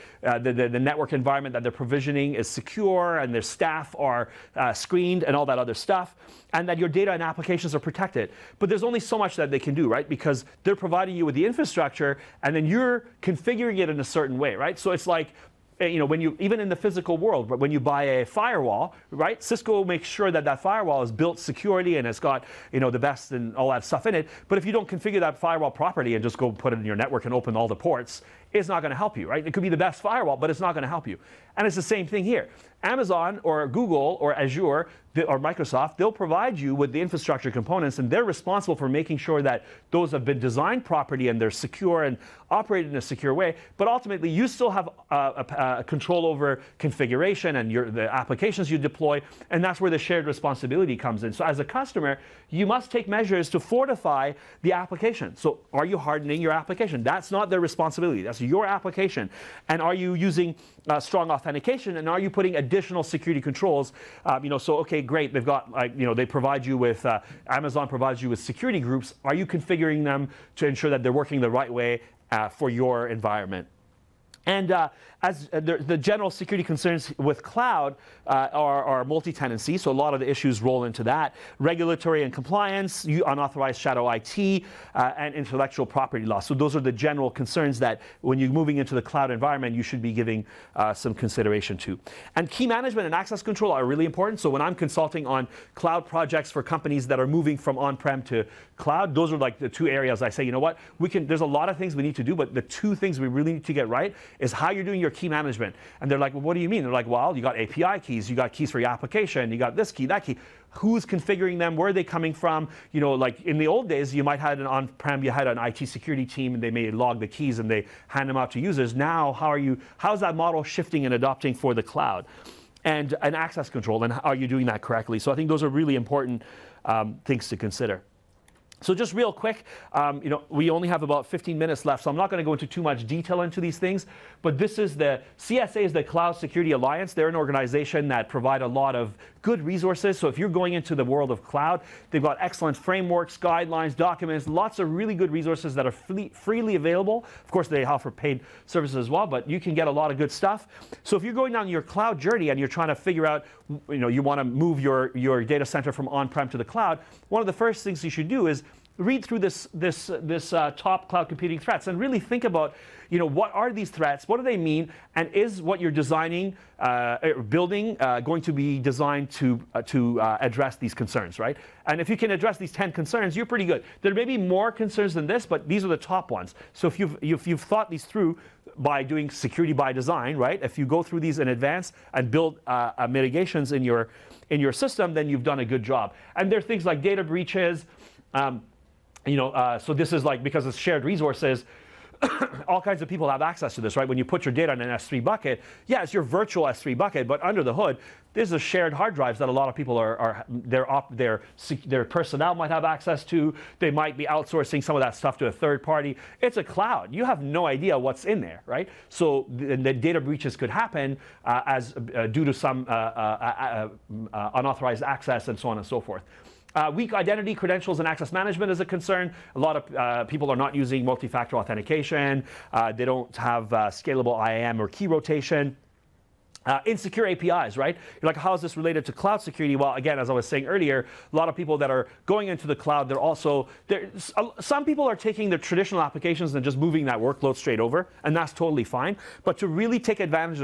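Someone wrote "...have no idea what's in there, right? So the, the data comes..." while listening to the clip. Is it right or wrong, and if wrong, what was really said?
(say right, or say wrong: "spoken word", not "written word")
wrong: "breaches", not "comes".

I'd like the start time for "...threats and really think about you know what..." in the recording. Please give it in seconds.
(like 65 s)
161 s.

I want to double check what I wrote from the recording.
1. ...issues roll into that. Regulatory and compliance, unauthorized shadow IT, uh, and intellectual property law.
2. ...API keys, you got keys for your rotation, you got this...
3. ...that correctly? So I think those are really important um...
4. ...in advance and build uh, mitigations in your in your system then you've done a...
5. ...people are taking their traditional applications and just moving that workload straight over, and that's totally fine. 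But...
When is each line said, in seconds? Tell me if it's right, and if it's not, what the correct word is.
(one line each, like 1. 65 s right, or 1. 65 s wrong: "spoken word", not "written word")
1. 80 s right
2. 107 s wrong: "application", not "rotation"
3. 124 s right
4. 181 s right
5. 234 s right.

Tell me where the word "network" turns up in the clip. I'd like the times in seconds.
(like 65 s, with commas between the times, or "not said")
0 s, 26 s.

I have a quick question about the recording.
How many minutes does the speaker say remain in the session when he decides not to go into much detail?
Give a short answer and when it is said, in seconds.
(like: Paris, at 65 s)
15, at 131 s.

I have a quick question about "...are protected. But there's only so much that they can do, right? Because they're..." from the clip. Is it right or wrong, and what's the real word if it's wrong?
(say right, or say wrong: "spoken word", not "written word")
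right.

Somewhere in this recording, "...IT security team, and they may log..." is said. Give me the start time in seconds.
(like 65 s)
115 s.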